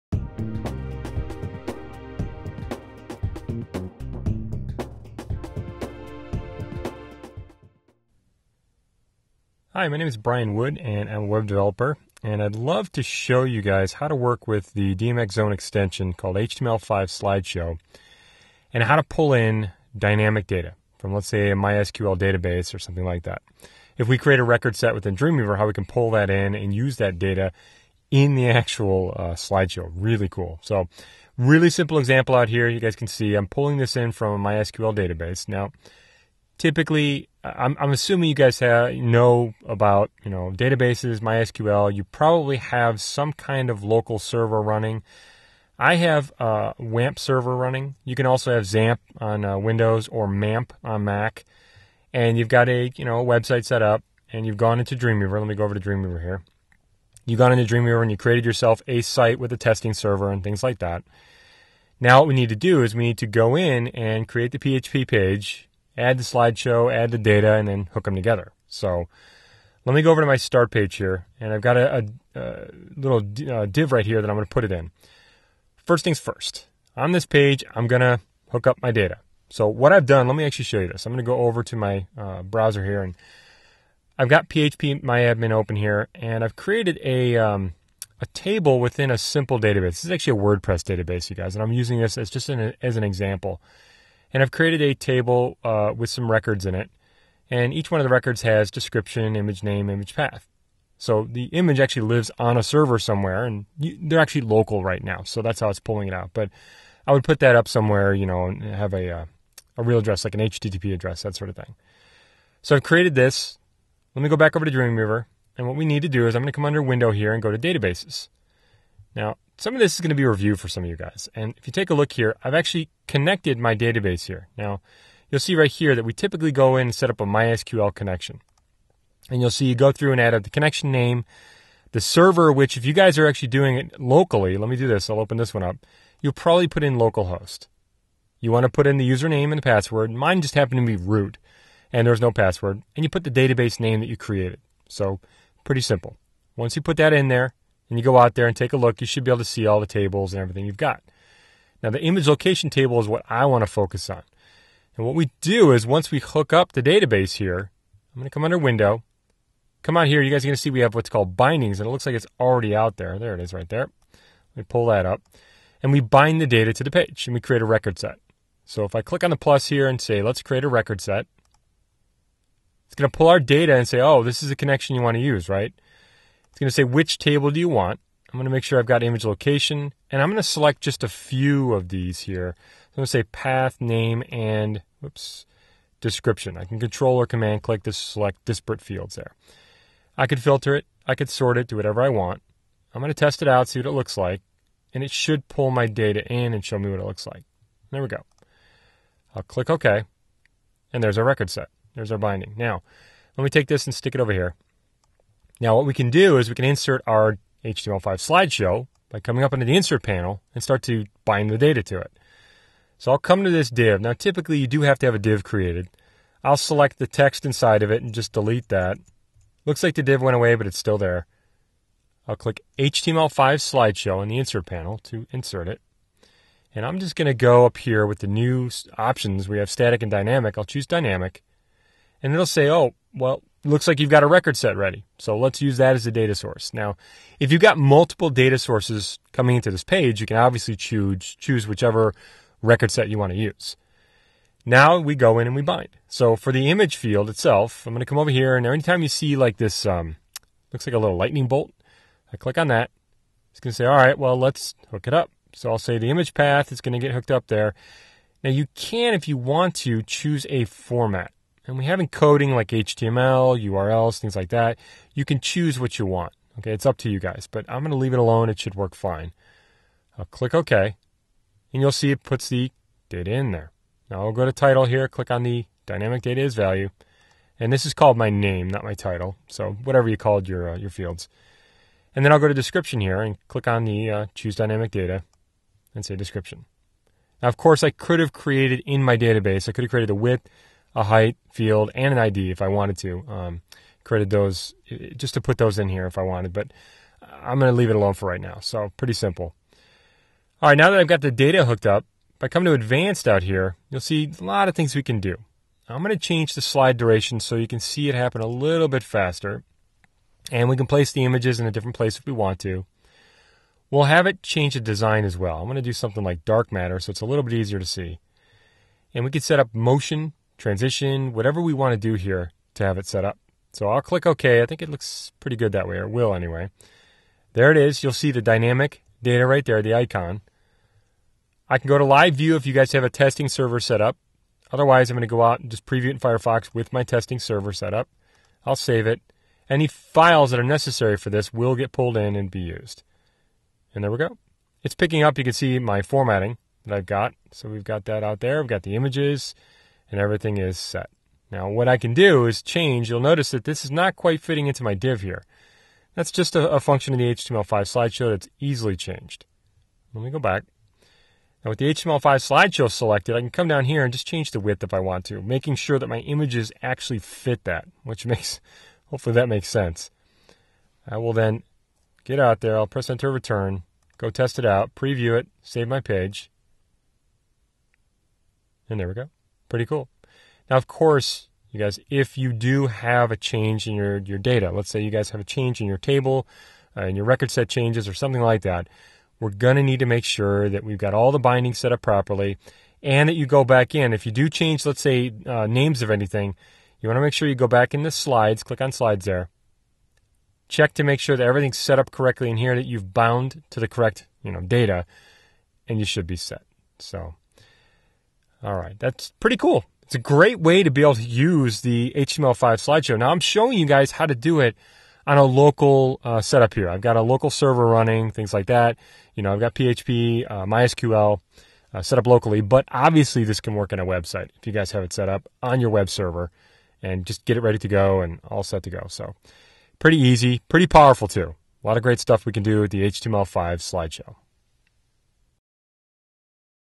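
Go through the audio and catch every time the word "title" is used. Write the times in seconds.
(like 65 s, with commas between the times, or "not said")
274 s, 278 s.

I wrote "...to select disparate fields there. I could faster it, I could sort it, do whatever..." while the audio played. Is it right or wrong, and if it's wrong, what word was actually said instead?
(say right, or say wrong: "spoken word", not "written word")
wrong: "filter", not "faster".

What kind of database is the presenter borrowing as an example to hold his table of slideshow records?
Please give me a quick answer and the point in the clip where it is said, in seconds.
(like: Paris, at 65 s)
WordPress database, at 90 s.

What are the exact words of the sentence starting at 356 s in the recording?
That's just a, a function of the HTML5 slideshow that's easily changed.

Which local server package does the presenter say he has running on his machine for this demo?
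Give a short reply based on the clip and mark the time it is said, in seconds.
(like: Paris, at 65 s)
WAMP server, at 46 s.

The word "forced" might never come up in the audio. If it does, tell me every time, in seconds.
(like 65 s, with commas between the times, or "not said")
not said.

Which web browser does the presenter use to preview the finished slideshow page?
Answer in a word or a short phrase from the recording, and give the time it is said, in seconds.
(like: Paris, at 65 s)
Firefox, at 336 s.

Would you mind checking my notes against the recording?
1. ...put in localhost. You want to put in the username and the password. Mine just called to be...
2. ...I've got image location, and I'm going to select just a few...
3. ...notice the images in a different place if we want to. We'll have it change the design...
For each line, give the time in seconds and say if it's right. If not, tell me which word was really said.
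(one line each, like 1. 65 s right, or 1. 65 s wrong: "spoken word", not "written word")
1. 136 s wrong: "happened", not "called"
2. 178 s right
3. 310 s wrong: "place", not "notice".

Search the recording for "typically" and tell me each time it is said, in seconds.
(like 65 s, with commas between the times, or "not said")
36 s, 126 s, 214 s.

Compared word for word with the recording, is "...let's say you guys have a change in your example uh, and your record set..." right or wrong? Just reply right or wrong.
wrong.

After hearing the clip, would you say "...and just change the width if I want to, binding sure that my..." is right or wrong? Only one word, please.
wrong.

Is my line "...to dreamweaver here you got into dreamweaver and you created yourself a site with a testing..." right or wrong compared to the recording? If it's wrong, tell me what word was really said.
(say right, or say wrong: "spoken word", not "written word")
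right.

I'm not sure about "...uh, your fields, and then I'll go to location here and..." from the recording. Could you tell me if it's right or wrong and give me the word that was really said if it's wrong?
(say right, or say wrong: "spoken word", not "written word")
wrong: "description", not "location".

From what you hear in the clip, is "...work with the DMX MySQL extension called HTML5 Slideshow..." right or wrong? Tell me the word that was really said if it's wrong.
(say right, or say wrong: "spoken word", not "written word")
wrong: "Zone", not "MySQL".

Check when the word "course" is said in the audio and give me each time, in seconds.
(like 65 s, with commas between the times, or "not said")
287 s, 380 s.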